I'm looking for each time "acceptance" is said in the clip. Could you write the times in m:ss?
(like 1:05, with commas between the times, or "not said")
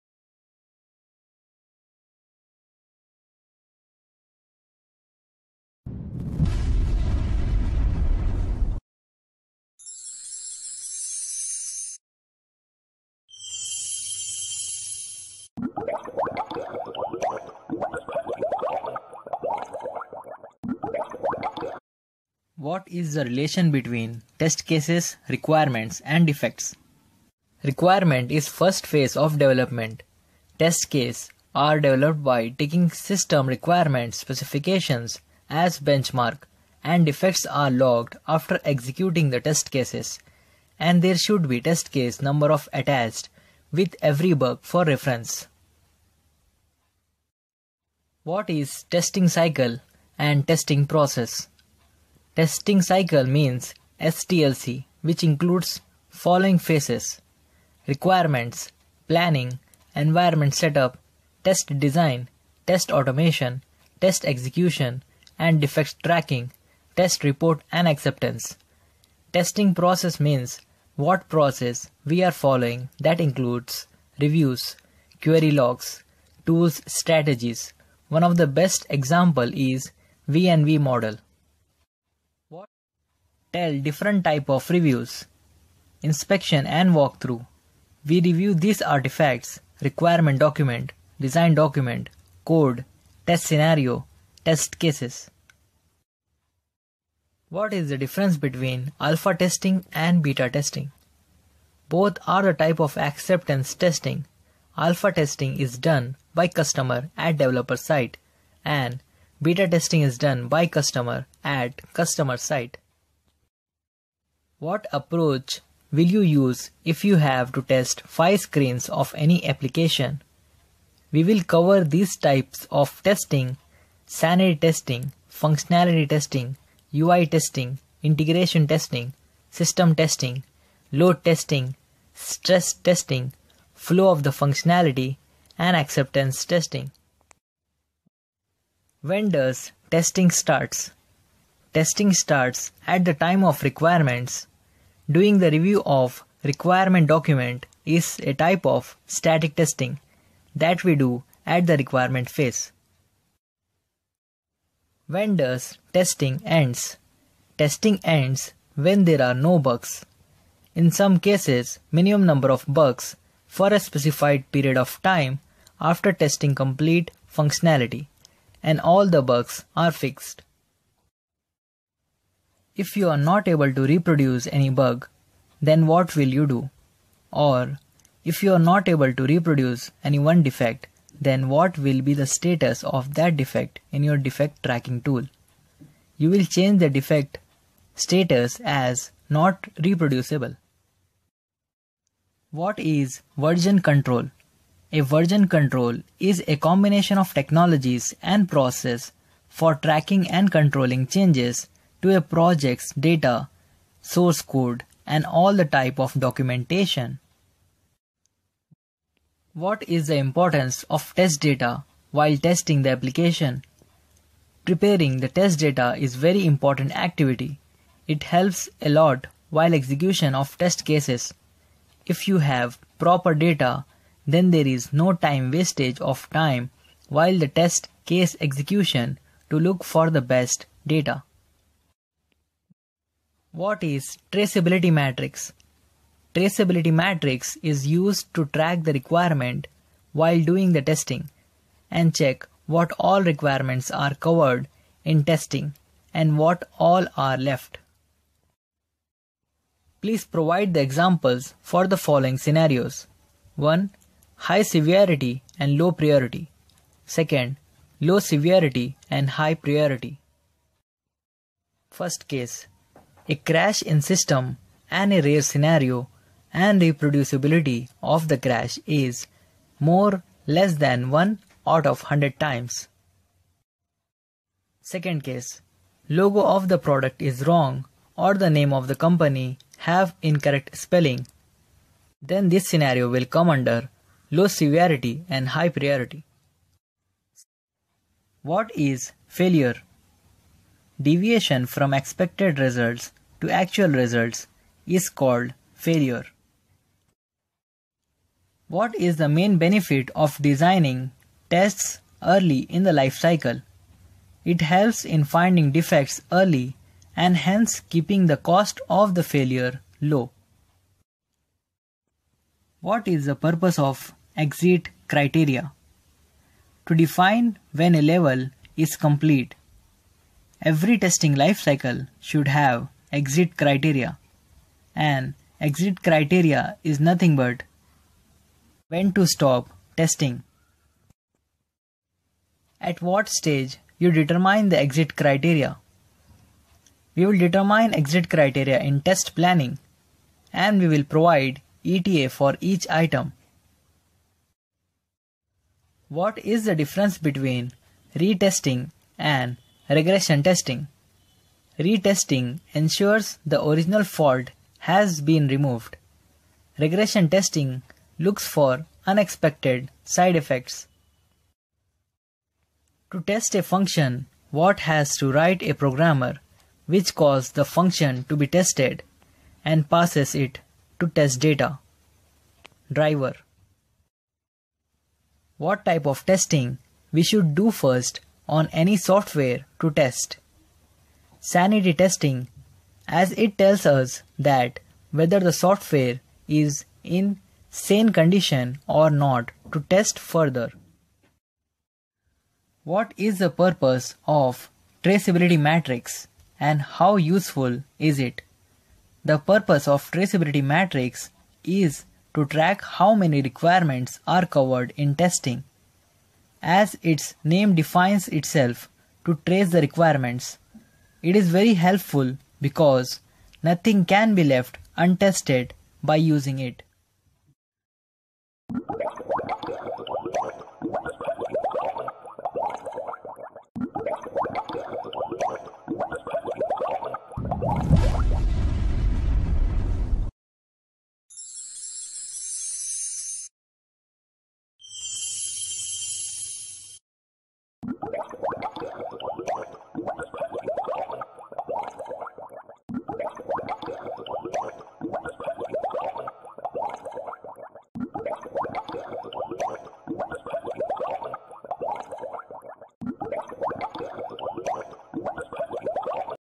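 1:07, 1:42, 2:15.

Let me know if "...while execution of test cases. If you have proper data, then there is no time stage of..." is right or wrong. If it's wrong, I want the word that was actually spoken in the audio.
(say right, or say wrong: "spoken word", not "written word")
wrong: "wastage", not "stage".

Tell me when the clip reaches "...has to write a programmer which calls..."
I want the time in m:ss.
6:04.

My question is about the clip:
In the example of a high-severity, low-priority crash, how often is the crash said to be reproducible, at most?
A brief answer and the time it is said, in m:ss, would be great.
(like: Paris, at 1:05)
1 out of 100 times, at 4:31.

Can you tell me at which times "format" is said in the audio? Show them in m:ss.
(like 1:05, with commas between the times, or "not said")
not said.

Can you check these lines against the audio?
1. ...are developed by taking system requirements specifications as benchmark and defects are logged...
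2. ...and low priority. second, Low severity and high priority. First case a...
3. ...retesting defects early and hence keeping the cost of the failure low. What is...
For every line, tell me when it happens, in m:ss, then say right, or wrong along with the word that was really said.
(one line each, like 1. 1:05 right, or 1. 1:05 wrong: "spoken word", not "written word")
1. 0:31 right
2. 4:15 right
3. 5:05 wrong: "finding", not "retesting".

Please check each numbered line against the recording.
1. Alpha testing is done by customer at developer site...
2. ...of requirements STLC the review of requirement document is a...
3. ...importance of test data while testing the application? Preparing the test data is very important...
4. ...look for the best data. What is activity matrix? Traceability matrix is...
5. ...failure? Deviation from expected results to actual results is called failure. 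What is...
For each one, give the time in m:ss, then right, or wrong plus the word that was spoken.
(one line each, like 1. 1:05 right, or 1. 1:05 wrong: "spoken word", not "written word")
1. 1:44 right
2. 2:23 wrong: "Doing", not "STLC"
3. 3:30 right
4. 3:49 wrong: "traceability", not "activity"
5. 4:49 right.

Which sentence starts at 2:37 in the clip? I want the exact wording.
Testing ends when there are no bugs.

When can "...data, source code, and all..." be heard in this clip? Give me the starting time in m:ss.
3:22.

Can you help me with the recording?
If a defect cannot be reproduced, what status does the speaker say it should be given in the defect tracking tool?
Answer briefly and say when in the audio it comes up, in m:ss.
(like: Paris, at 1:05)
Not reproducible, at 3:09.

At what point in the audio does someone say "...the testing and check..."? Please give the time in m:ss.
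4:00.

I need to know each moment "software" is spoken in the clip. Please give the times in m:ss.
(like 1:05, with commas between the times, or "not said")
6:18, 6:25.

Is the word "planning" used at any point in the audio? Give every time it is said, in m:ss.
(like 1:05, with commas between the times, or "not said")
0:59, 5:39.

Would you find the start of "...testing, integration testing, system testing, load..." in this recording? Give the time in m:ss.
2:07.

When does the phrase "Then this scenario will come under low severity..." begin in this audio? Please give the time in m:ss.
4:42.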